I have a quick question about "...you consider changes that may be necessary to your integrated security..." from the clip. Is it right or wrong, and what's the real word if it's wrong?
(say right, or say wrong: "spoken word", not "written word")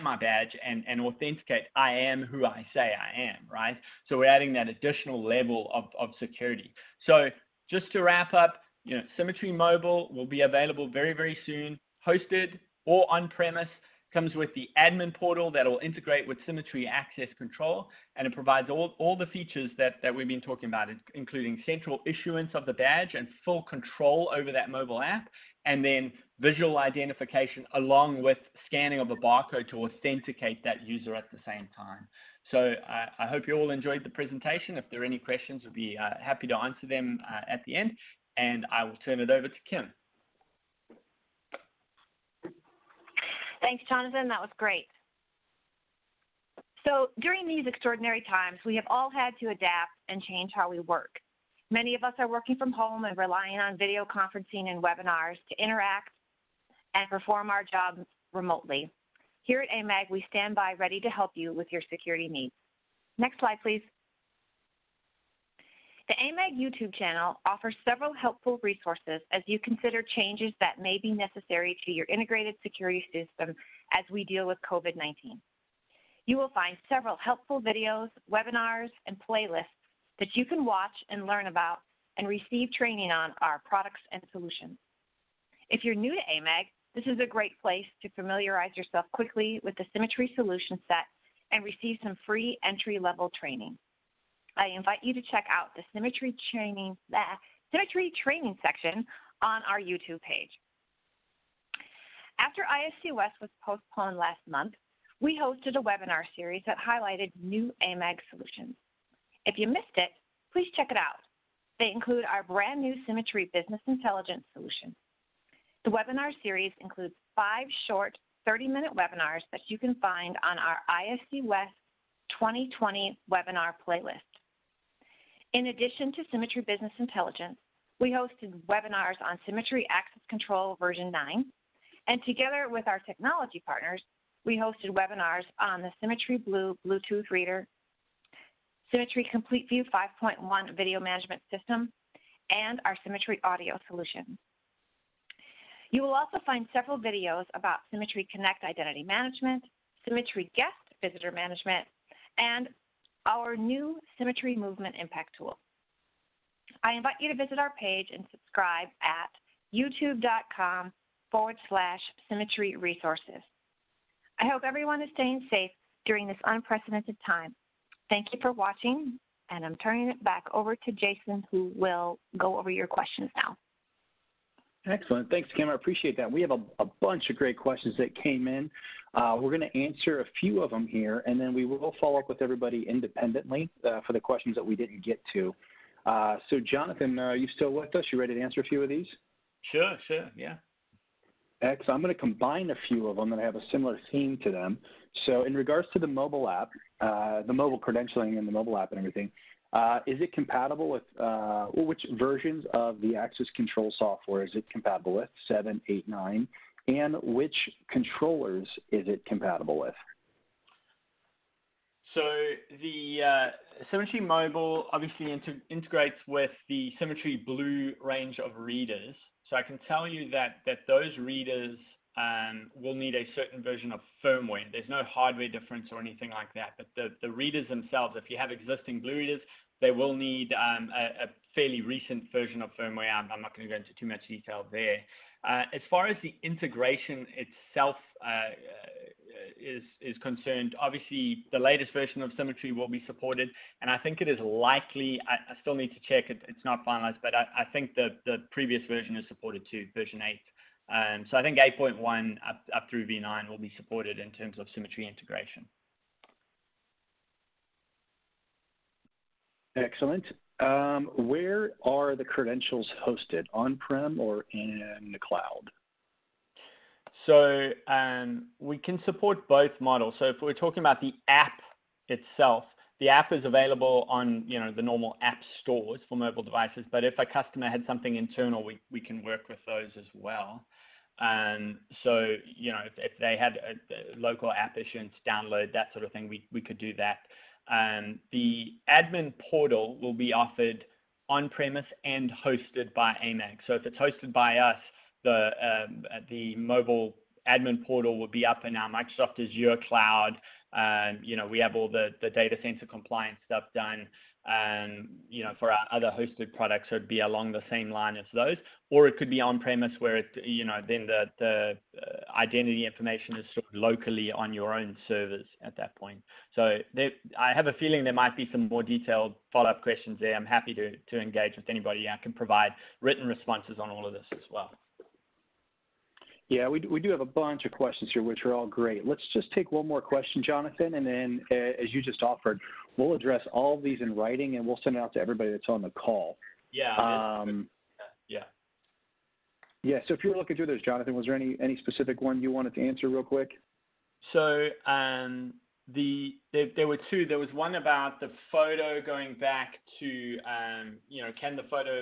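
right.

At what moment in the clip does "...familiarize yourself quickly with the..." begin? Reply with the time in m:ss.
1:28.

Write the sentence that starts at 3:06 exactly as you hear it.
Uh, so, Jonathan, uh, are you still with us?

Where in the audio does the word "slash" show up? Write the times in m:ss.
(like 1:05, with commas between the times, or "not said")
2:41.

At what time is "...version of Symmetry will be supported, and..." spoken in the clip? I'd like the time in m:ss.
4:01.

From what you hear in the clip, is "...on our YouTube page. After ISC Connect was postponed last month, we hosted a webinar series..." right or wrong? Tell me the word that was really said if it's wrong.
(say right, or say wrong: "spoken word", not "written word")
wrong: "West", not "Connect".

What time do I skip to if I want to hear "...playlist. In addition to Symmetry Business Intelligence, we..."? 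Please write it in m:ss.
2:03.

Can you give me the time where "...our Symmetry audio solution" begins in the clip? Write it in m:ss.
2:22.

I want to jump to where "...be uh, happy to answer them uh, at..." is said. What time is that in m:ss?
0:35.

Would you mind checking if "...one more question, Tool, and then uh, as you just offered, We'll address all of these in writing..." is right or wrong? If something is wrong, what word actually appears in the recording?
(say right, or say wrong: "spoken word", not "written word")
wrong: "Jonathan", not "Tool".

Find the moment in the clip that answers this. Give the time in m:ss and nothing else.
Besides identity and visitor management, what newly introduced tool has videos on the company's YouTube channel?
2:34.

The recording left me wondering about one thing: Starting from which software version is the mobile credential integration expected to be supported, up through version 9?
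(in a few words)
8.1.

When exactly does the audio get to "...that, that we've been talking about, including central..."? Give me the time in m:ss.
0:19.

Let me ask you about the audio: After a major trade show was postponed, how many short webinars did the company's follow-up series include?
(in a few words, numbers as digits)
5.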